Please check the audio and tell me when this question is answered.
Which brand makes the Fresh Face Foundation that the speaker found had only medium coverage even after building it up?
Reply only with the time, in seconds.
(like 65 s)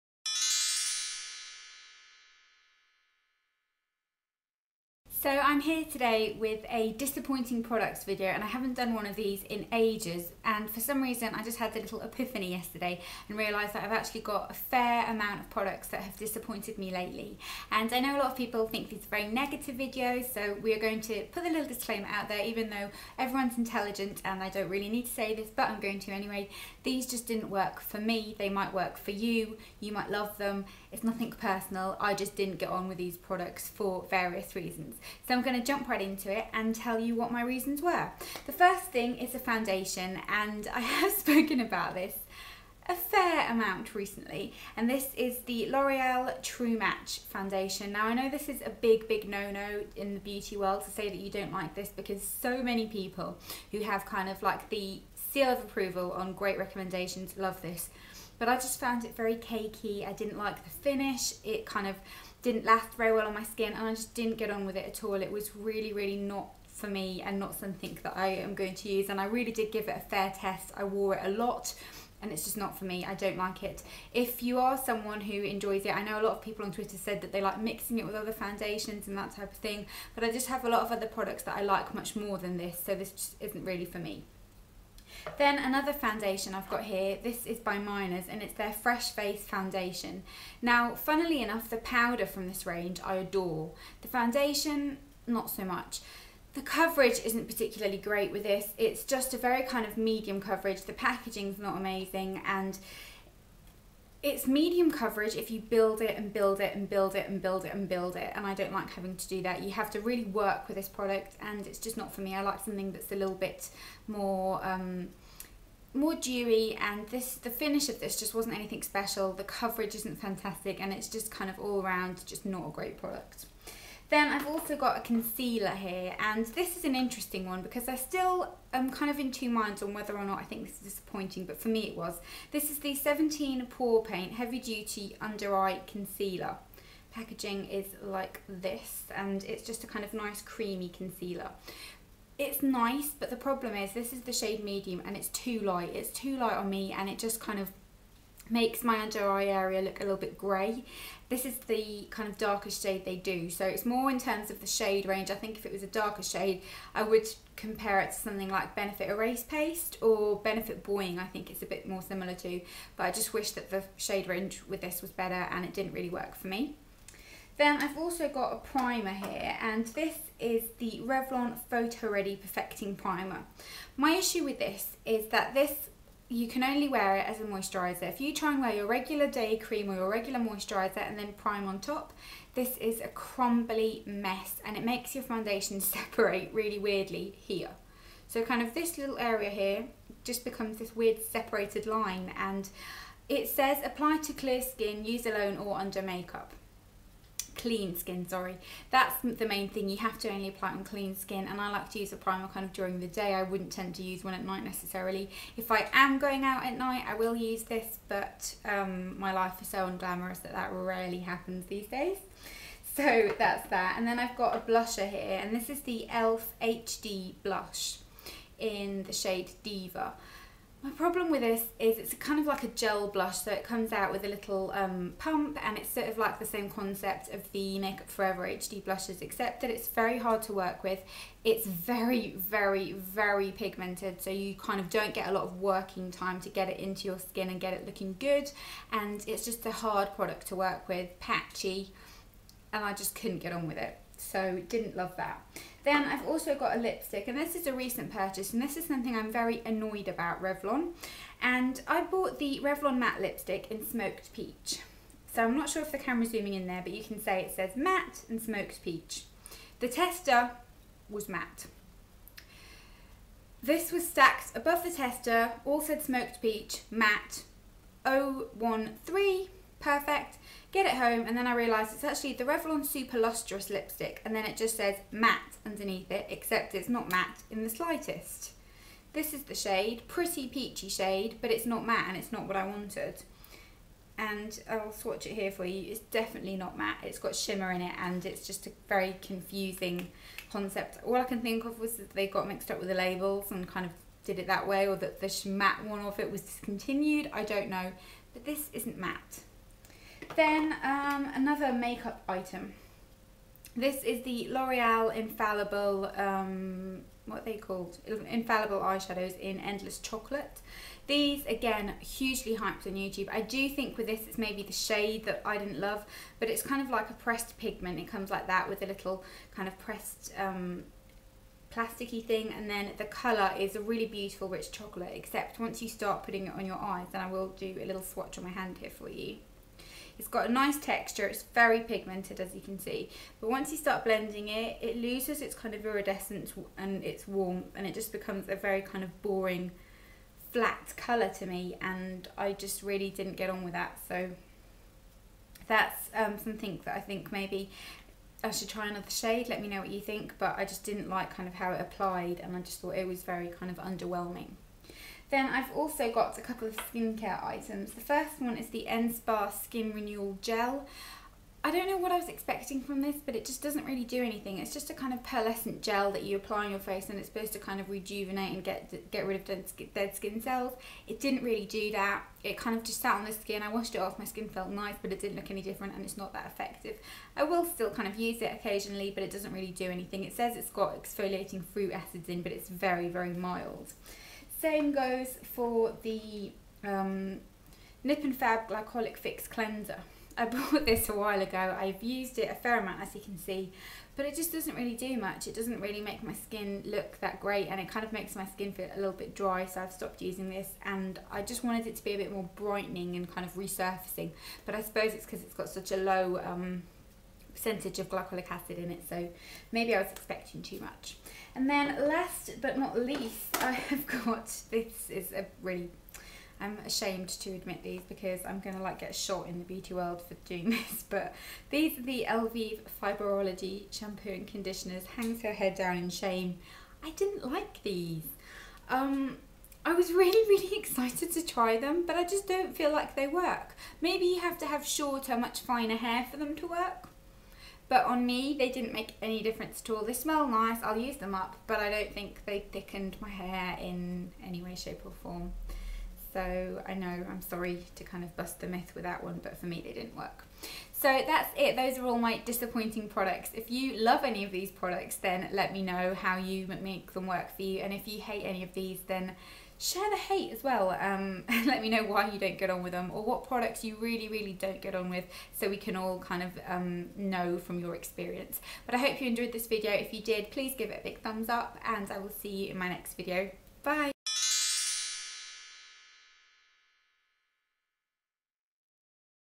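87 s.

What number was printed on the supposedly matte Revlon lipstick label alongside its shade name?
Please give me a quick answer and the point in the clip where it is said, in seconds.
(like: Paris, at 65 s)
013, at 268 s.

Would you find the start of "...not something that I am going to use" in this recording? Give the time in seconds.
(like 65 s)
67 s.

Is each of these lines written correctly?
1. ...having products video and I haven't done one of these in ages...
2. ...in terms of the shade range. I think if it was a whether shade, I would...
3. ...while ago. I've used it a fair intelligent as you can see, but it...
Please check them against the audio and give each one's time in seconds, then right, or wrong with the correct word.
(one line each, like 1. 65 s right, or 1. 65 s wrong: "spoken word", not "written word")
1. 6 s wrong: "disappointing", not "having"
2. 154 s wrong: "darker", not "whether"
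3. 391 s wrong: "amount", not "intelligent".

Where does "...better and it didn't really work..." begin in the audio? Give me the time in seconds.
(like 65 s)
165 s.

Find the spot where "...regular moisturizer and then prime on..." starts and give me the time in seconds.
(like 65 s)
180 s.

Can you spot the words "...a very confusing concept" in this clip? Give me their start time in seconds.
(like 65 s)
288 s.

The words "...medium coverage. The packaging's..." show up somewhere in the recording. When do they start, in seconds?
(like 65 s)
99 s.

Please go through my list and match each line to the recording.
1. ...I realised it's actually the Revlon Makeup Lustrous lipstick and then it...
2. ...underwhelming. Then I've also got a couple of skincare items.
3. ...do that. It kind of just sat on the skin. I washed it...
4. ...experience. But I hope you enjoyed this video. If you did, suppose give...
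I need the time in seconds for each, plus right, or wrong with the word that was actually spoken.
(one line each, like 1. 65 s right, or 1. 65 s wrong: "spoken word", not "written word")
1. 271 s wrong: "Super", not "Makeup"
2. 353 s right
3. 371 s right
4. 467 s wrong: "please", not "suppose".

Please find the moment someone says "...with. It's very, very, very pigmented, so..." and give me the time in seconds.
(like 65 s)
230 s.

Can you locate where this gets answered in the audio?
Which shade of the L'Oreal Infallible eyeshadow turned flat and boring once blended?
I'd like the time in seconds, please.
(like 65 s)
309 s.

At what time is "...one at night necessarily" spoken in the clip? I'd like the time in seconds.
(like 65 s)
204 s.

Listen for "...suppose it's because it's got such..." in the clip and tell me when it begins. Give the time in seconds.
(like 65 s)
404 s.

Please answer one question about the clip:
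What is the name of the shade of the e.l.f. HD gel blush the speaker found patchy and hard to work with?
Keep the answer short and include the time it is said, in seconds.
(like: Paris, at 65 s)
Diva, at 219 s.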